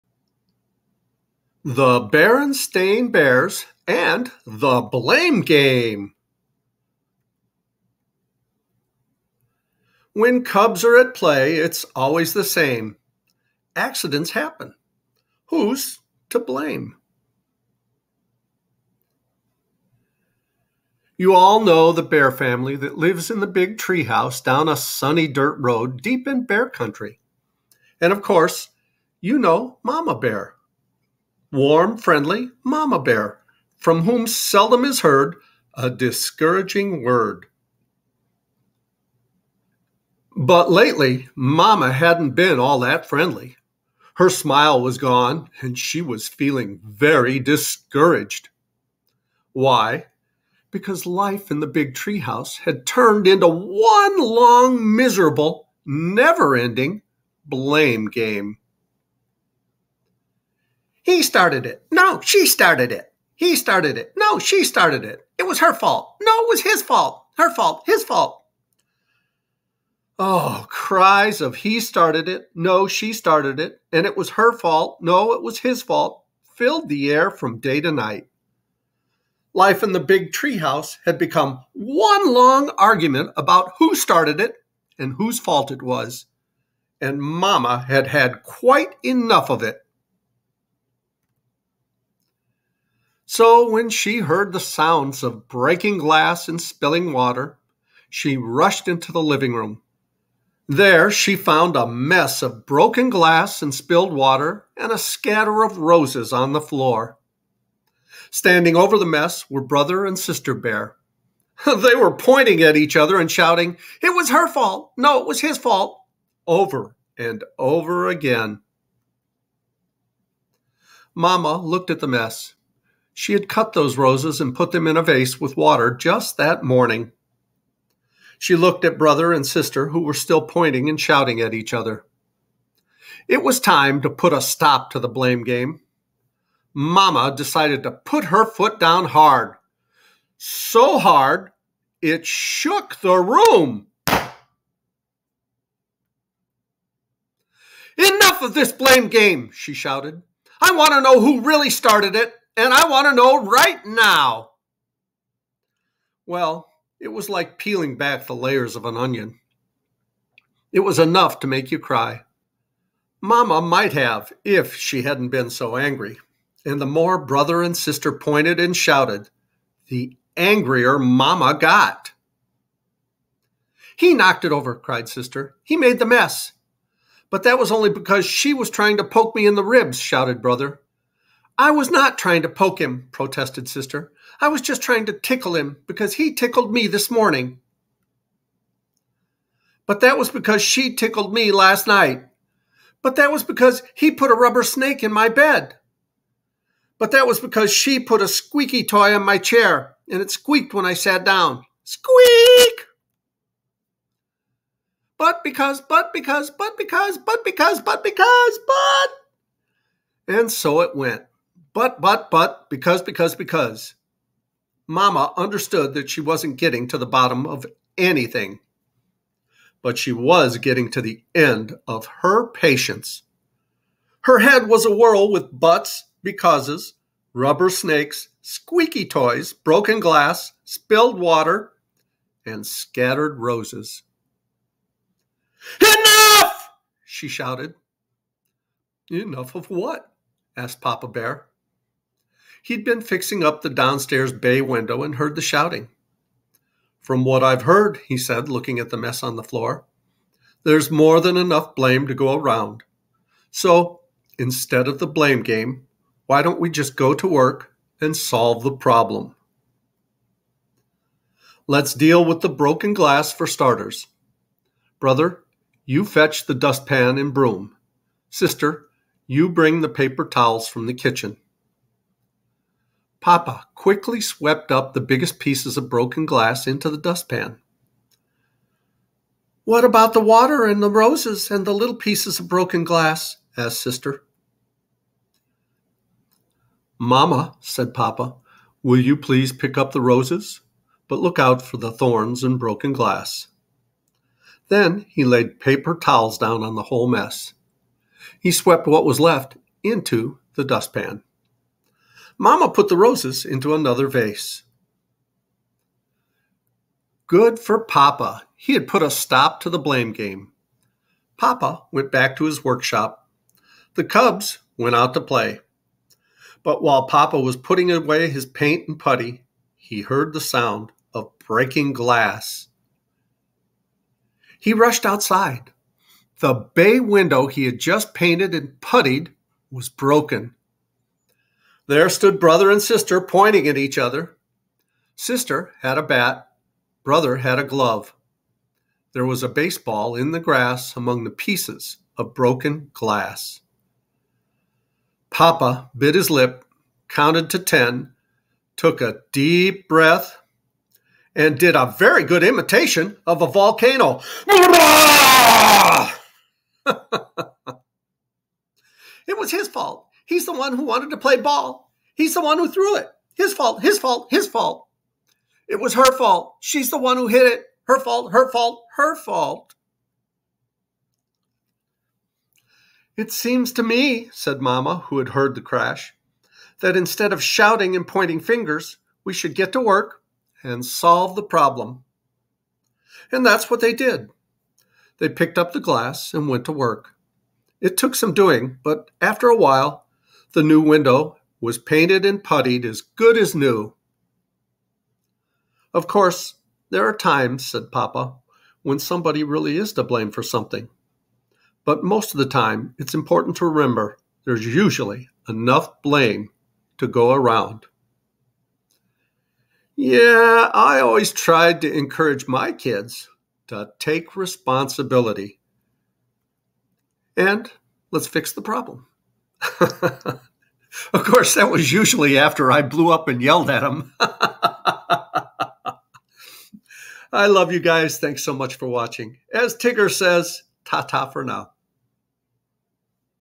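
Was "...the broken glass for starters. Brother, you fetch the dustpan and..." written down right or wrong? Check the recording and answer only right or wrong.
right.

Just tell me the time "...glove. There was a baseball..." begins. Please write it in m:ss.
5:37.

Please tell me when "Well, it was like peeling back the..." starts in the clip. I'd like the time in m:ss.
2:36.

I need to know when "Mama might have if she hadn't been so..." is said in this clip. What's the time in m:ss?
2:43.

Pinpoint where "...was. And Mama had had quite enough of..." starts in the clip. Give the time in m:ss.
1:25.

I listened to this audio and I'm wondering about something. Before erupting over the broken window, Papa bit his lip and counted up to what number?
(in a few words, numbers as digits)
10.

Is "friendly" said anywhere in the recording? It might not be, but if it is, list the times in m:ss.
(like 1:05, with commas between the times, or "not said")
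0:31, 0:43.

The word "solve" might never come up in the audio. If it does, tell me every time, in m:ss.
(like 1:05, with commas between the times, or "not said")
4:18, 6:20.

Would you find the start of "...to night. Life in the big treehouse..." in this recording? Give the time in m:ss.
1:17.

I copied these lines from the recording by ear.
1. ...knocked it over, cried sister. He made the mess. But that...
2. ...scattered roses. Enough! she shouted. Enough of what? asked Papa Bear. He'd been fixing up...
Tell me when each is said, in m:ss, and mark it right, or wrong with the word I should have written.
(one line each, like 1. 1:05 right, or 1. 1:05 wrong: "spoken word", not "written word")
1. 2:54 right
2. 3:52 right.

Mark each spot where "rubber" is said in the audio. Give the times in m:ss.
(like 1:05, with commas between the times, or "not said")
3:14, 3:47.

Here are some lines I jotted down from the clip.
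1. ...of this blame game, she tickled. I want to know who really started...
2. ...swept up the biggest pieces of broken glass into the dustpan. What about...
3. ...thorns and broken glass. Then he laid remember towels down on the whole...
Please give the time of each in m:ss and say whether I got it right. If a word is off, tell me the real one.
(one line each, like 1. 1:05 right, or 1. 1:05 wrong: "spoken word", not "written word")
1. 2:28 wrong: "shouted", not "tickled"
2. 4:34 right
3. 4:51 wrong: "paper", not "remember".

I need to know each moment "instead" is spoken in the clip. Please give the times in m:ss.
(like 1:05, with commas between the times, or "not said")
4:14, 6:16.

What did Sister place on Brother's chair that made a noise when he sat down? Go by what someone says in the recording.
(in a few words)
Squeaky toy.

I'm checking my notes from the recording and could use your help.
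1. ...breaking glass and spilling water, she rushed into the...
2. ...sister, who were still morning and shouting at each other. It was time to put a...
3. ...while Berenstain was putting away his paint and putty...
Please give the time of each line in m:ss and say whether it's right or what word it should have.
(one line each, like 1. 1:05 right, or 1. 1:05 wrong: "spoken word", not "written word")
1. 1:35 right
2. 2:09 wrong: "pointing", not "morning"
3. 5:16 wrong: "Papa", not "Berenstain".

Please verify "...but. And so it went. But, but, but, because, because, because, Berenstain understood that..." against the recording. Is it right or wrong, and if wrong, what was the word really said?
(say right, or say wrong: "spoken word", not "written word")
wrong: "Mama", not "Berenstain".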